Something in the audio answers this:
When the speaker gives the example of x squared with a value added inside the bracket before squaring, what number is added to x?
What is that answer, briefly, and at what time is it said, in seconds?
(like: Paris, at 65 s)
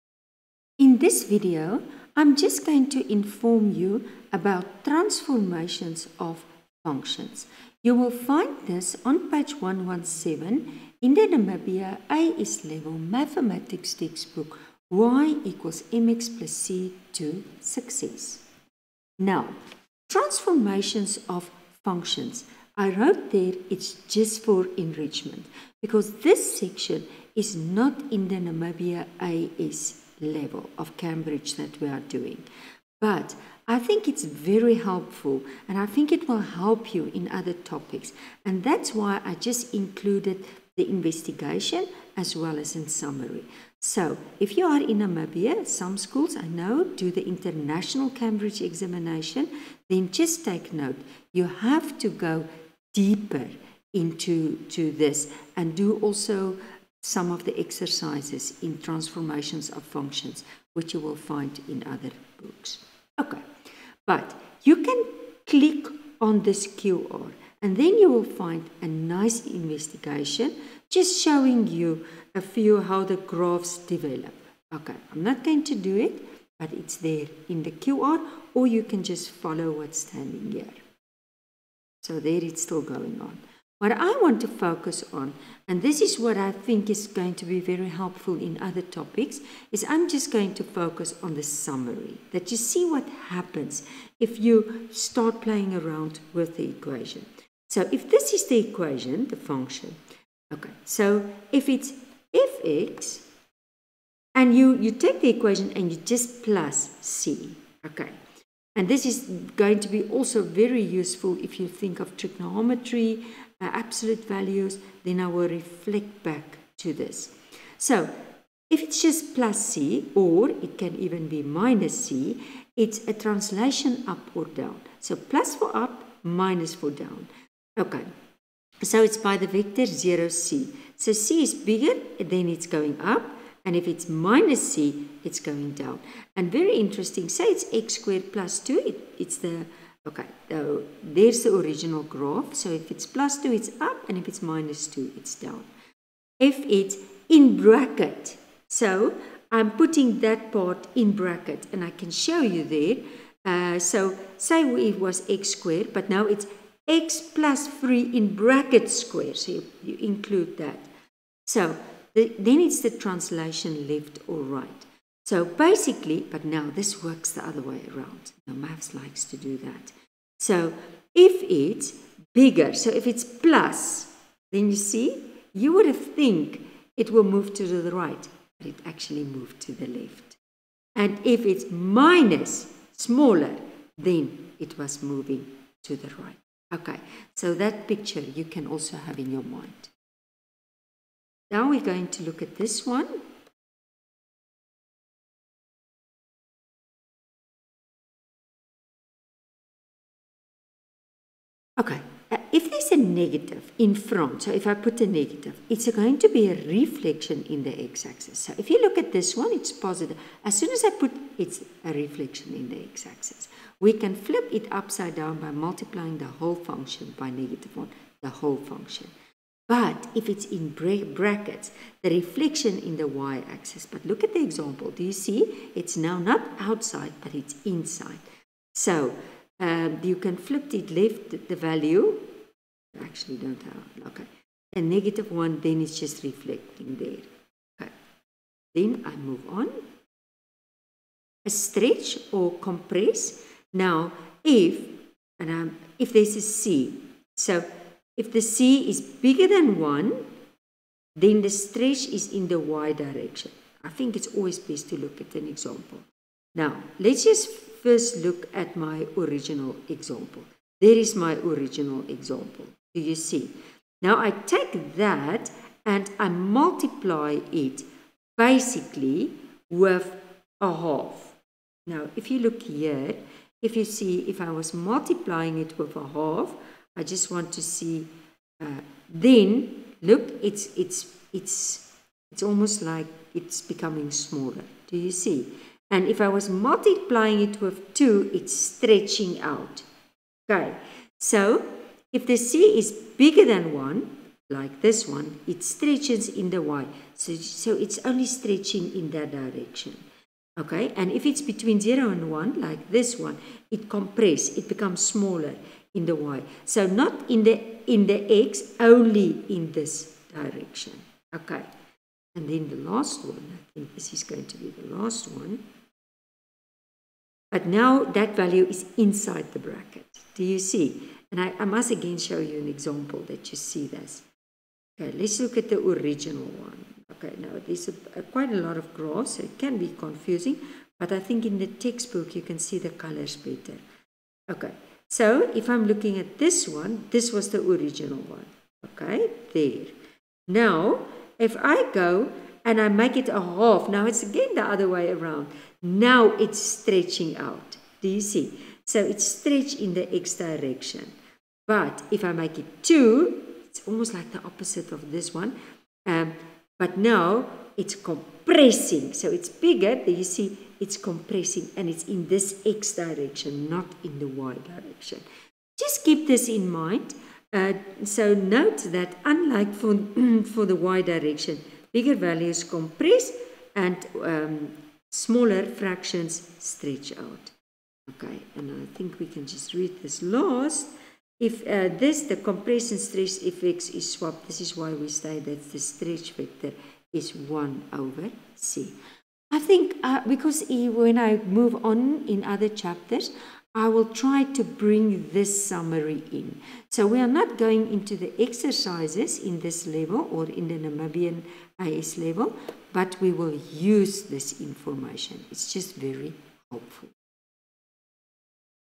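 3, at 156 s.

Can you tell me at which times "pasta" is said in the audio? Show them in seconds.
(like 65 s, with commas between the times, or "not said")
not said.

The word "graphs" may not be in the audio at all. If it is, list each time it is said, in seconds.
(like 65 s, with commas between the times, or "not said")
73 s, 142 s, 328 s.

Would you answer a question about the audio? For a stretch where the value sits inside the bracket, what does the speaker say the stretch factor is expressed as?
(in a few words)
1 over C.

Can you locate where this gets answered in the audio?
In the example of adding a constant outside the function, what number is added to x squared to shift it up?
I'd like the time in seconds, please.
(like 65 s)
137 s.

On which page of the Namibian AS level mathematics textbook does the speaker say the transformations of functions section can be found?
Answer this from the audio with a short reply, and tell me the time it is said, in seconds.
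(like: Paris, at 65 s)
117, at 9 s.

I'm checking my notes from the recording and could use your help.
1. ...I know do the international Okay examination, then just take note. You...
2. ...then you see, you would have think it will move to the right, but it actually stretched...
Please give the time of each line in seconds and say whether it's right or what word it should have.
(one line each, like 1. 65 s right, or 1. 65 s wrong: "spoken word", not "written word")
1. 46 s wrong: "Cambridge", not "Okay"
2. 174 s wrong: "moved", not "stretched".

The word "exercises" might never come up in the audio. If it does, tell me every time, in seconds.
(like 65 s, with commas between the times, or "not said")
57 s, 398 s.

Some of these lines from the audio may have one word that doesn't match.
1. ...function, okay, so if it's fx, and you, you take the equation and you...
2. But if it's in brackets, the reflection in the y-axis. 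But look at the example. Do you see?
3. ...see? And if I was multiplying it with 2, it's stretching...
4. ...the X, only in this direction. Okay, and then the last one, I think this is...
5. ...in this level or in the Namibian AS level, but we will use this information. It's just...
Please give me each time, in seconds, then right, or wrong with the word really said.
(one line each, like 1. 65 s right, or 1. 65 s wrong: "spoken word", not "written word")
1. 99 s right
2. 219 s right
3. 285 s right
4. 308 s right
5. 399 s right.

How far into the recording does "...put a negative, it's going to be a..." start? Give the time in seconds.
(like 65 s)
204 s.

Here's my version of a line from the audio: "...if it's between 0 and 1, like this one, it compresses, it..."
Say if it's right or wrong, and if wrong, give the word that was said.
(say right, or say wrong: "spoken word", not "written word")
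right.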